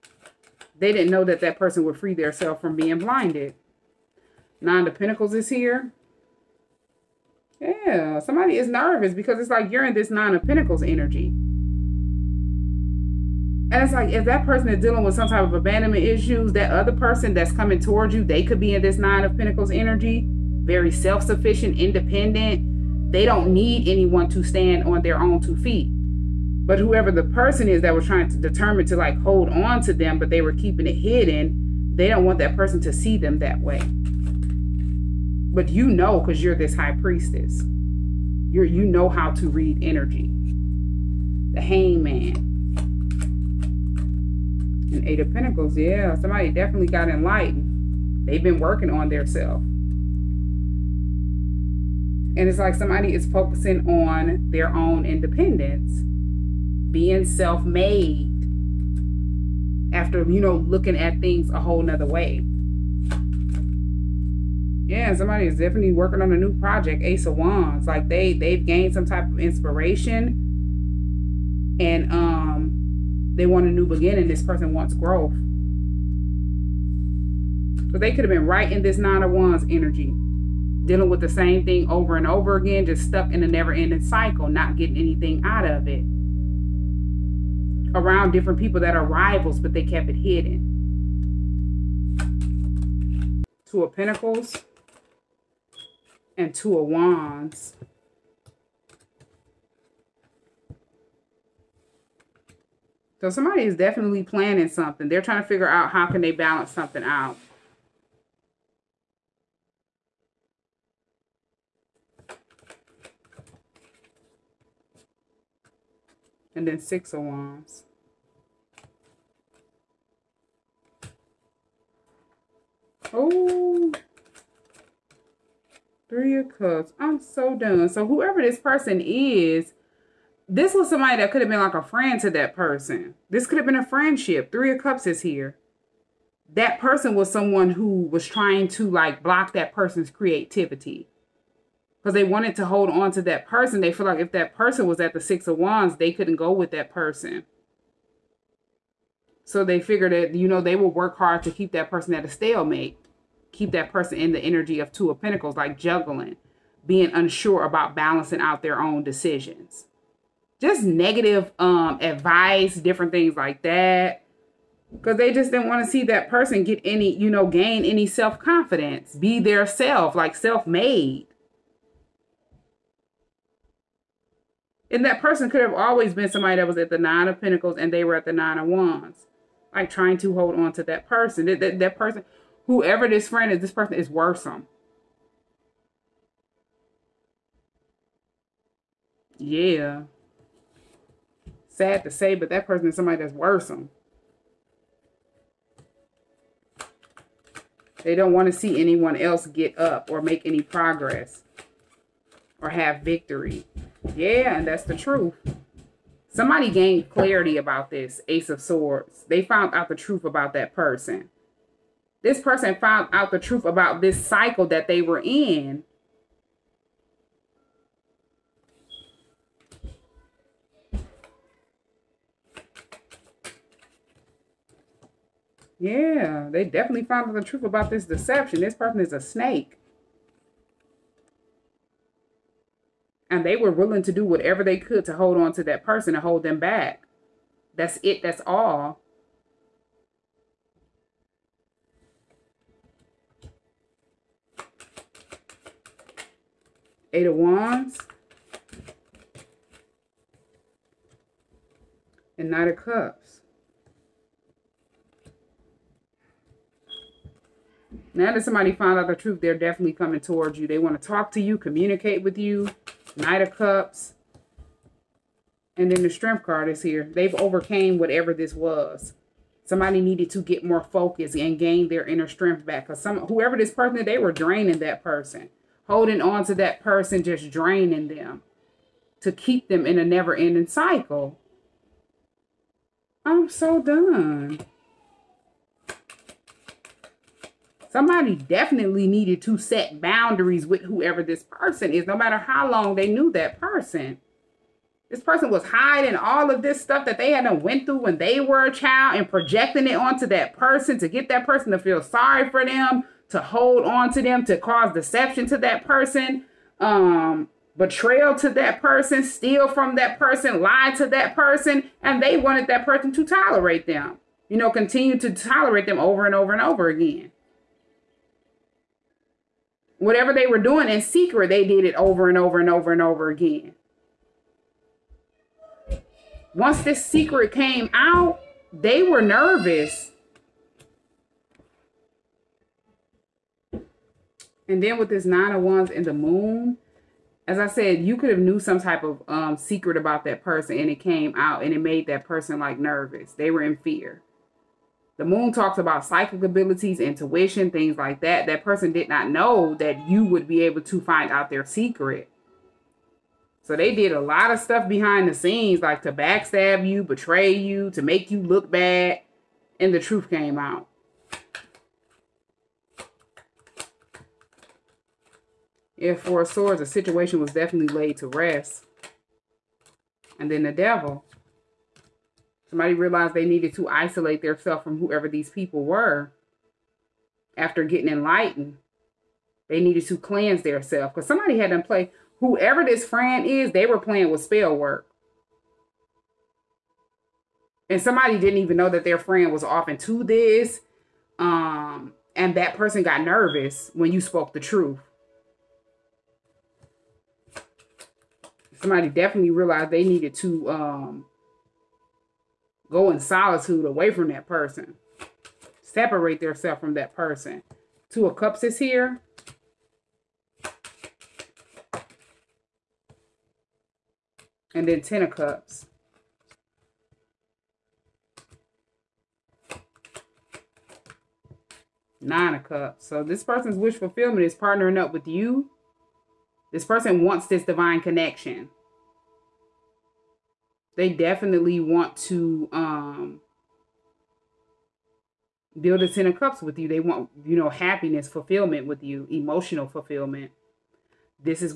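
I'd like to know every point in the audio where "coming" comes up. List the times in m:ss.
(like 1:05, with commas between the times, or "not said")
0:17, 4:19.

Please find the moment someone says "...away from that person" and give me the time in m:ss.
6:43.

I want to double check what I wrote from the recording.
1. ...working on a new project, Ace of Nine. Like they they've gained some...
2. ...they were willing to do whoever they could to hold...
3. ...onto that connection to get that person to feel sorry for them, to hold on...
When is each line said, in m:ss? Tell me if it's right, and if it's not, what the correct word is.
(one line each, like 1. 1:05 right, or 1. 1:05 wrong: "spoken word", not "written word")
1. 1:05 wrong: "Wands", not "Nine"
2. 3:53 wrong: "whatever", not "whoever"
3. 4:59 wrong: "person", not "connection".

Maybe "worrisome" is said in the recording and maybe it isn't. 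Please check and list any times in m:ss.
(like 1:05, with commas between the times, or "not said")
3:04, 3:13.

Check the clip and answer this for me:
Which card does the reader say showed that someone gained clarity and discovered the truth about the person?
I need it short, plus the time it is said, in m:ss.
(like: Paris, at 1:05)
Ace of Swords, at 3:28.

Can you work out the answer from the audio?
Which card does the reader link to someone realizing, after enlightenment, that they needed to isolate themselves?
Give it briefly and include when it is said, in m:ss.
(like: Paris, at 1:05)
The Devil, at 6:10.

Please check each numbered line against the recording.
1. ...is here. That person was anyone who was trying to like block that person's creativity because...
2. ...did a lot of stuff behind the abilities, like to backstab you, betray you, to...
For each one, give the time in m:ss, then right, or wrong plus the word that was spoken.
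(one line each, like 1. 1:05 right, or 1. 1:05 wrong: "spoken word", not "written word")
1. 2:15 wrong: "someone", not "anyone"
2. 5:53 wrong: "scenes", not "abilities".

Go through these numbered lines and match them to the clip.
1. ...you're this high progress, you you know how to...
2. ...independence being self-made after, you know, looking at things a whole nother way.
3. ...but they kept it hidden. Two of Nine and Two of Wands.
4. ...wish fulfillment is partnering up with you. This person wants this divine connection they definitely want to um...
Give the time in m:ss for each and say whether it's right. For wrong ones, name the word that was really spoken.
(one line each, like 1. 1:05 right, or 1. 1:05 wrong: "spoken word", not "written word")
1. 0:36 wrong: "priestess", not "progress"
2. 0:55 right
3. 1:29 wrong: "Pentacles", not "Nine"
4. 7:03 right.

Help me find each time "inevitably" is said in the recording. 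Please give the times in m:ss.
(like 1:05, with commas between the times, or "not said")
not said.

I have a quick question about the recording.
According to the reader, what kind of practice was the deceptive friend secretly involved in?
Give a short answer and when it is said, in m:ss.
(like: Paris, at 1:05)
Spell work, at 6:24.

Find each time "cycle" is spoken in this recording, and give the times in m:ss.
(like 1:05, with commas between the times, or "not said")
1:23, 3:34, 4:40.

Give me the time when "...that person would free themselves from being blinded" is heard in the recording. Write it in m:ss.
0:01.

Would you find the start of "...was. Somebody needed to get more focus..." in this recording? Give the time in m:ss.
4:28.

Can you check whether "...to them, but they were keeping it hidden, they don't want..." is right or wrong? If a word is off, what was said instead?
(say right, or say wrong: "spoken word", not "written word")
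right.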